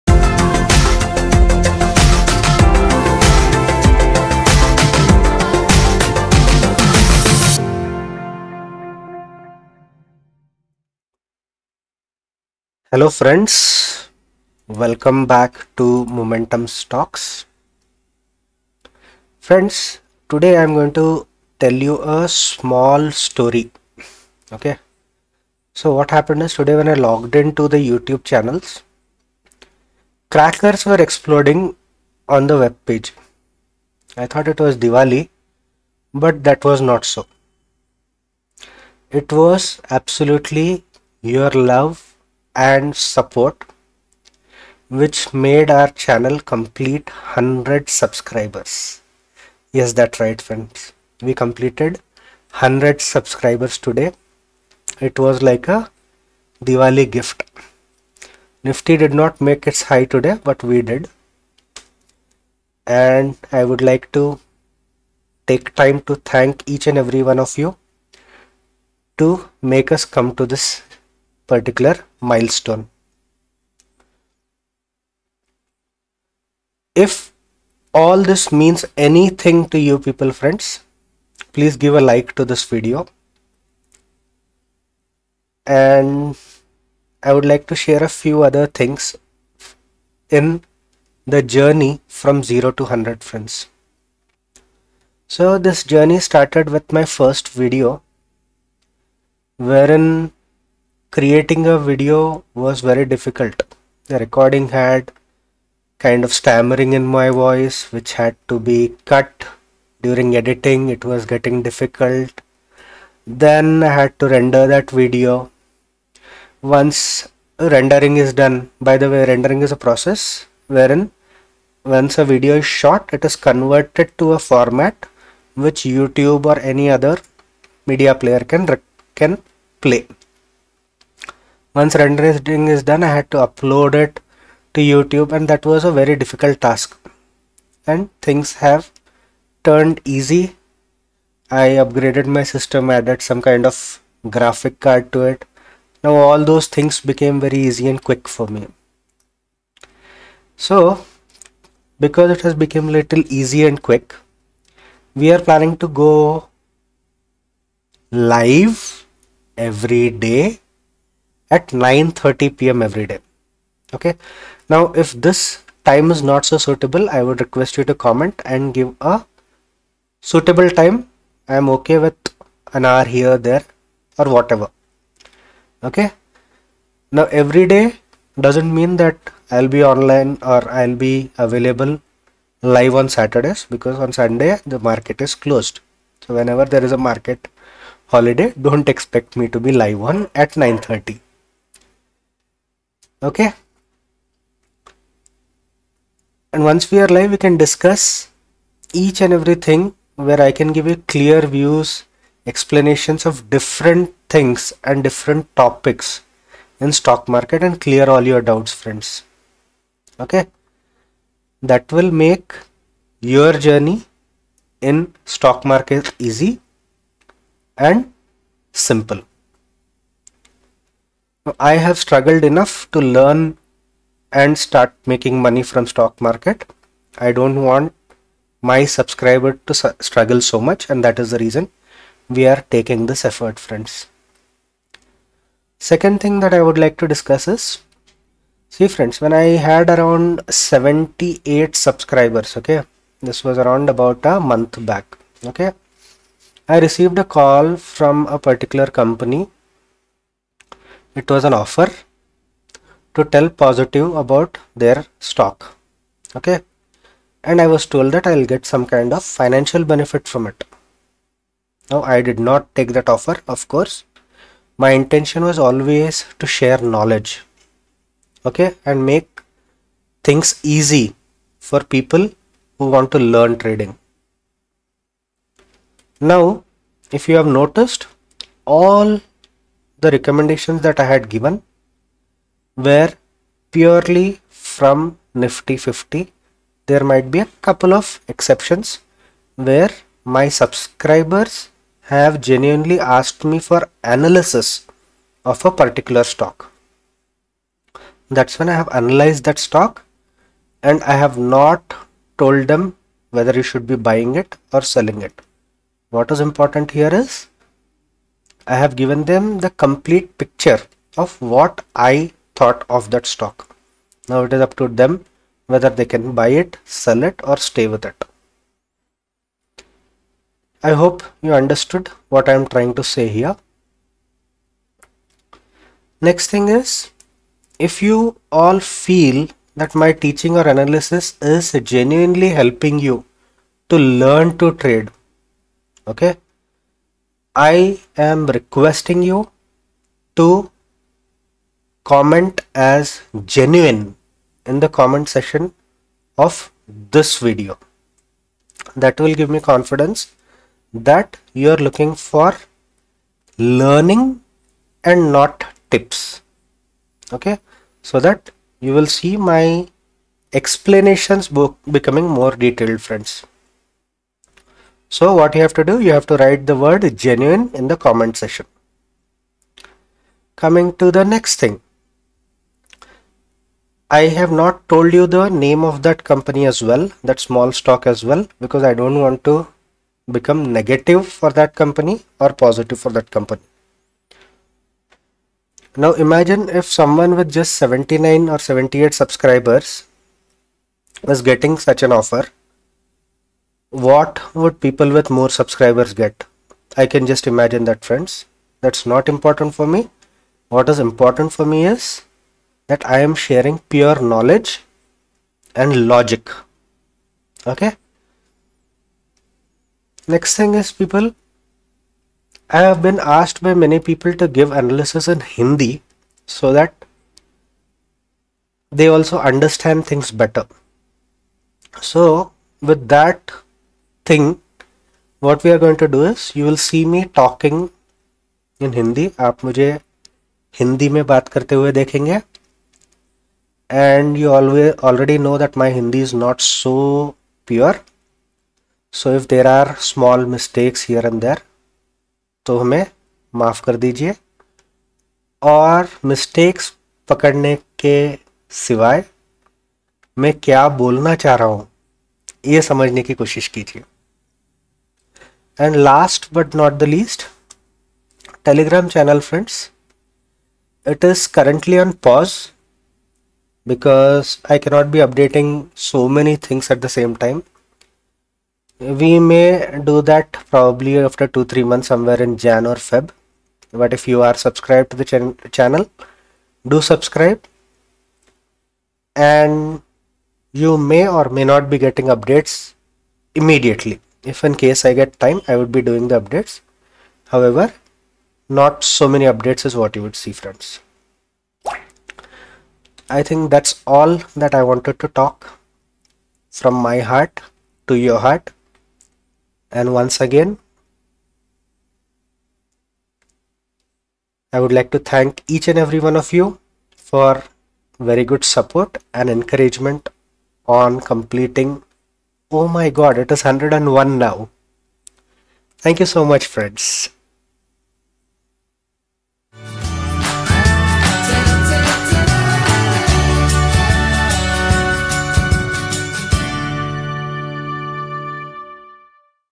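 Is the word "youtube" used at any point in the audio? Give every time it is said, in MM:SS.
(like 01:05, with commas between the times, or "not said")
00:27, 02:05, 02:14.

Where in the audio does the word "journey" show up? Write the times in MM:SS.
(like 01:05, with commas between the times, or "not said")
01:31, 01:35, 03:33.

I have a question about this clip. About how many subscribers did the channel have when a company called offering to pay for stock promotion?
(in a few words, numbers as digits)
78.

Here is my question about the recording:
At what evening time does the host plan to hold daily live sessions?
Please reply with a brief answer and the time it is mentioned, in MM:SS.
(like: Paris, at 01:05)
9:30 p.m., at 02:41.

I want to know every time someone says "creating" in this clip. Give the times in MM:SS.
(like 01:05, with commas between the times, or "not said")
01:41.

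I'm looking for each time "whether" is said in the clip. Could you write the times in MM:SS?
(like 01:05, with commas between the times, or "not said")
05:03, 05:15.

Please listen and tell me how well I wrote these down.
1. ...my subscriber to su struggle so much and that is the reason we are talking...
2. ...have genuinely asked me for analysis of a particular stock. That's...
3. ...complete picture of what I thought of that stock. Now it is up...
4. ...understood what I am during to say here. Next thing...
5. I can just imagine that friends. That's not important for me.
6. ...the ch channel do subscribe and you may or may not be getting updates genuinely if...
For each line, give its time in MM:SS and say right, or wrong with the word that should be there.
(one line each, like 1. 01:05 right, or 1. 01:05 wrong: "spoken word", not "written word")
1. 03:48 wrong: "taking", not "talking"
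2. 04:52 right
3. 05:09 right
4. 05:21 wrong: "trying", not "during"
5. 06:36 right
6. 07:55 wrong: "immediately", not "genuinely".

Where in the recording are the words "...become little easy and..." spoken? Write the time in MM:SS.
02:32.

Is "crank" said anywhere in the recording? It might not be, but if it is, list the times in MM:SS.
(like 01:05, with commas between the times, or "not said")
not said.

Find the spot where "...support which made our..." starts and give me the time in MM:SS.
00:42.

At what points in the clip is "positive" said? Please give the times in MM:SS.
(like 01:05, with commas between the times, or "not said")
04:13, 06:22.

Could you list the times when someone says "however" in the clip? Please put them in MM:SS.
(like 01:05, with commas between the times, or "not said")
08:07.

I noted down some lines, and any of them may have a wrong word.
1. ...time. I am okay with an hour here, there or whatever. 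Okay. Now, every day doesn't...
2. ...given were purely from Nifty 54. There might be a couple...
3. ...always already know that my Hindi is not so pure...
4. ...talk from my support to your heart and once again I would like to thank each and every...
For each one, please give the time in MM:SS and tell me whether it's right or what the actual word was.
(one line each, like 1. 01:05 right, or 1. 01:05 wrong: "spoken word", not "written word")
1. 02:50 right
2. 04:41 wrong: "50", not "54"
3. 07:14 right
4. 08:15 wrong: "heart", not "support".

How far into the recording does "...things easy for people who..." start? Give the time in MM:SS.
04:30.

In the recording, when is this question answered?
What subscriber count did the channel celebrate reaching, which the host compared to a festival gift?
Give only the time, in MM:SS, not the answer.
00:52.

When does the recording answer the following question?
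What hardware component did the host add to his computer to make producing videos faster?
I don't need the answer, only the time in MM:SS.
02:24.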